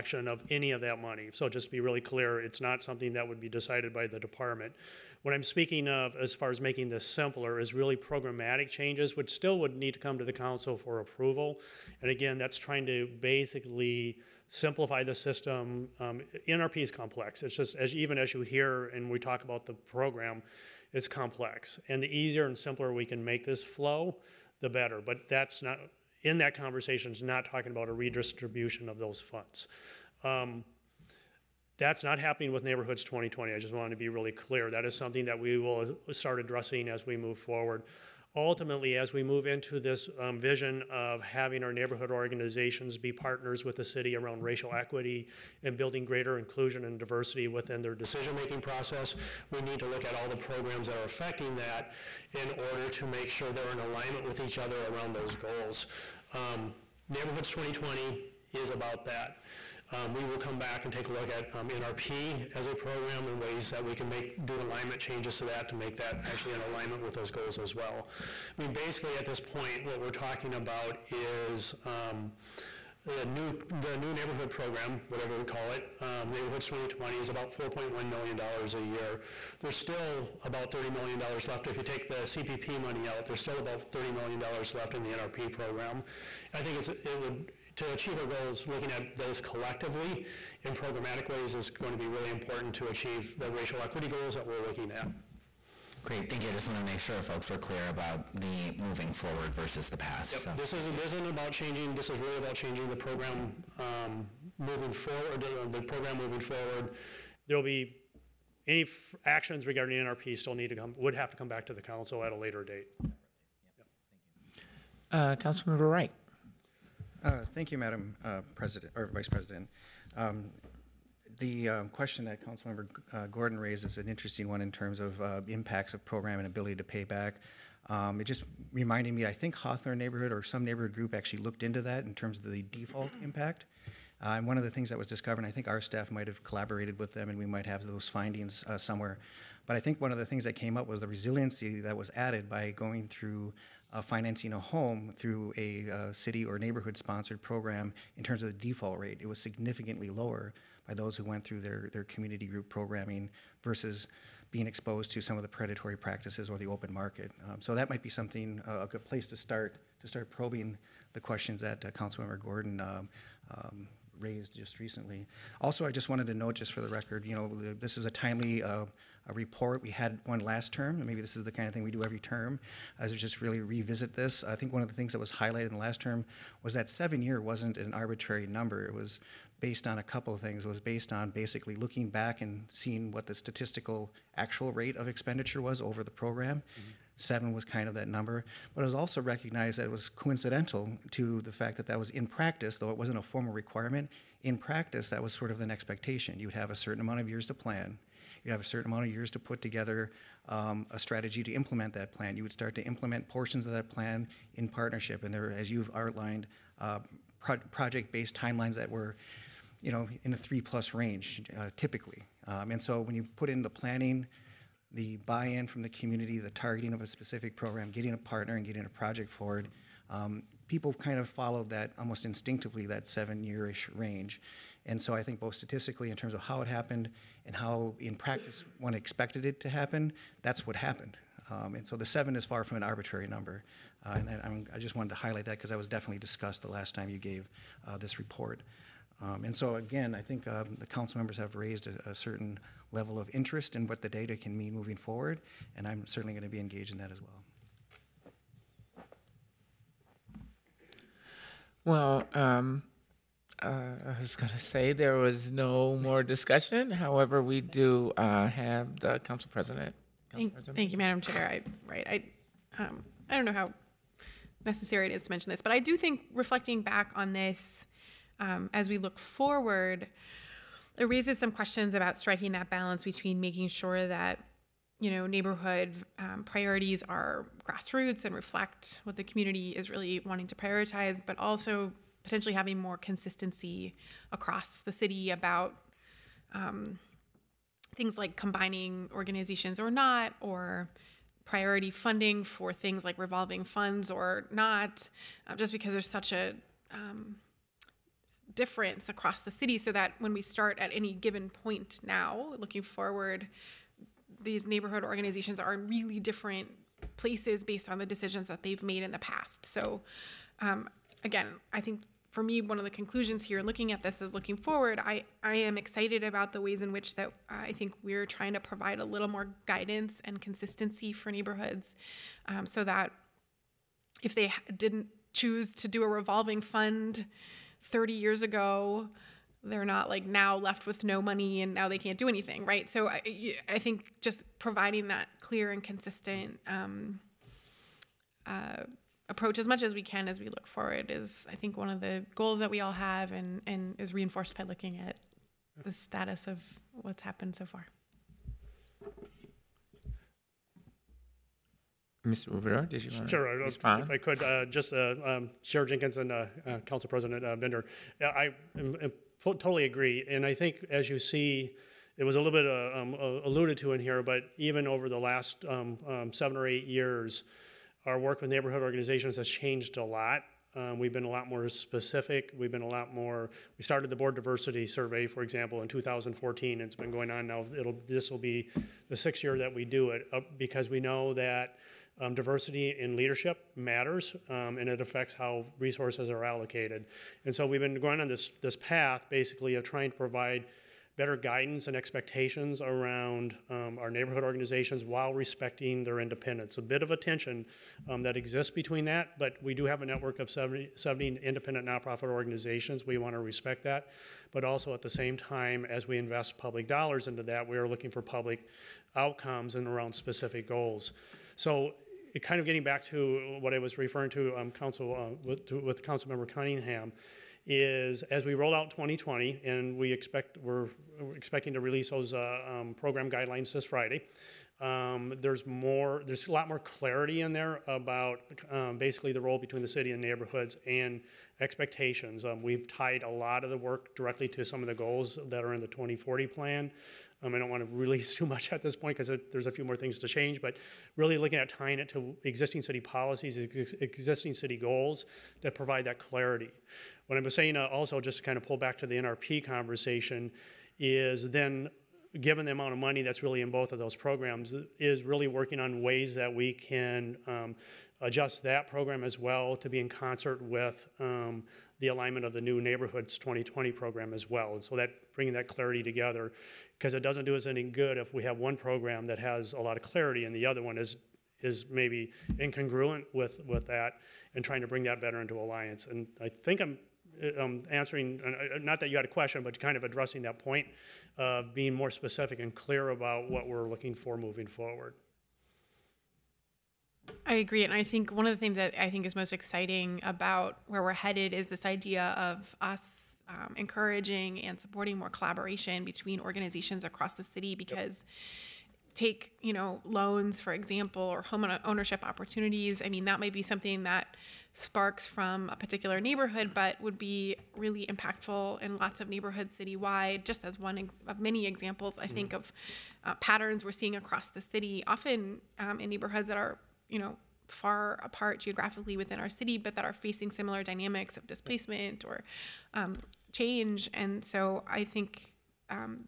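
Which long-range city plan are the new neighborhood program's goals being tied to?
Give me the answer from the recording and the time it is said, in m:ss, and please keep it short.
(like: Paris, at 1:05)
2040 plan, at 7:15.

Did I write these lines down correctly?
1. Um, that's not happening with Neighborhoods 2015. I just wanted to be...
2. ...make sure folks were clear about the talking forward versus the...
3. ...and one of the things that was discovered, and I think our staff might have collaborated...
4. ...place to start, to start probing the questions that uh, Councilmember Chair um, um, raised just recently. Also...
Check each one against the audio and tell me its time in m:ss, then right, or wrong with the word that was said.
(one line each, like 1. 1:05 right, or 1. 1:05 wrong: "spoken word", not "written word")
1. 0:30 wrong: "2020", not "2015"
2. 1:36 wrong: "moving", not "talking"
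3. 2:14 right
4. 2:39 wrong: "Gordon", not "Chair".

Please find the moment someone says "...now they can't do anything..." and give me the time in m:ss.
5:31.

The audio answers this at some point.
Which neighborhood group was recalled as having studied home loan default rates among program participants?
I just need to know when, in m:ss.
2:09.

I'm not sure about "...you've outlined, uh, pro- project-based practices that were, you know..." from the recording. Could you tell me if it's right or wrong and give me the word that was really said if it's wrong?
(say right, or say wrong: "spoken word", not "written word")
wrong: "timelines", not "practices".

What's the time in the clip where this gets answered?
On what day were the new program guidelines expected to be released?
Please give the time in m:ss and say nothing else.
7:03.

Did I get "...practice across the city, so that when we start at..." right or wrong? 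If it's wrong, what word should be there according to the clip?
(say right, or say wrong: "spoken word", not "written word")
wrong: "difference", not "practice".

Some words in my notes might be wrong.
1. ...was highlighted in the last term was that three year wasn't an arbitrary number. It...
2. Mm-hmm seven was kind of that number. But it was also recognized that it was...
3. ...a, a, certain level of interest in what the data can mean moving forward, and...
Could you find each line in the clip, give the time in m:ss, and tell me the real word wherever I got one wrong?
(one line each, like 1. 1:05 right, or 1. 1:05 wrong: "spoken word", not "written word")
1. 2:55 wrong: "seven", not "three"
2. 3:06 right
3. 4:01 right.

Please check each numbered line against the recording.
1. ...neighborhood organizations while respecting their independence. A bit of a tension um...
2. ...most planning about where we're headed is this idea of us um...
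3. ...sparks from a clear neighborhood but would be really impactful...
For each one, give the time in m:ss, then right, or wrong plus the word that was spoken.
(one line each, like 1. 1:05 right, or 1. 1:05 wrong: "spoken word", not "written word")
1. 6:34 right
2. 8:09 wrong: "exciting", not "planning"
3. 8:24 wrong: "particular", not "clear".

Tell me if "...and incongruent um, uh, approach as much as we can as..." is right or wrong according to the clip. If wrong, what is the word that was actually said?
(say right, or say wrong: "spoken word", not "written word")
wrong: "consistent", not "incongruent".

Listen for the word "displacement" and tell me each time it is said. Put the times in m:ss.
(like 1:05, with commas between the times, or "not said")
8:41.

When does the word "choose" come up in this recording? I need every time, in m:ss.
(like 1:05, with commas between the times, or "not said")
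5:25.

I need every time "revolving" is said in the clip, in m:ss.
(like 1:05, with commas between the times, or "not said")
4:53, 5:26.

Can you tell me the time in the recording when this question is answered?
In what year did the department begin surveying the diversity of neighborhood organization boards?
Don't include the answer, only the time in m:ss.
6:15.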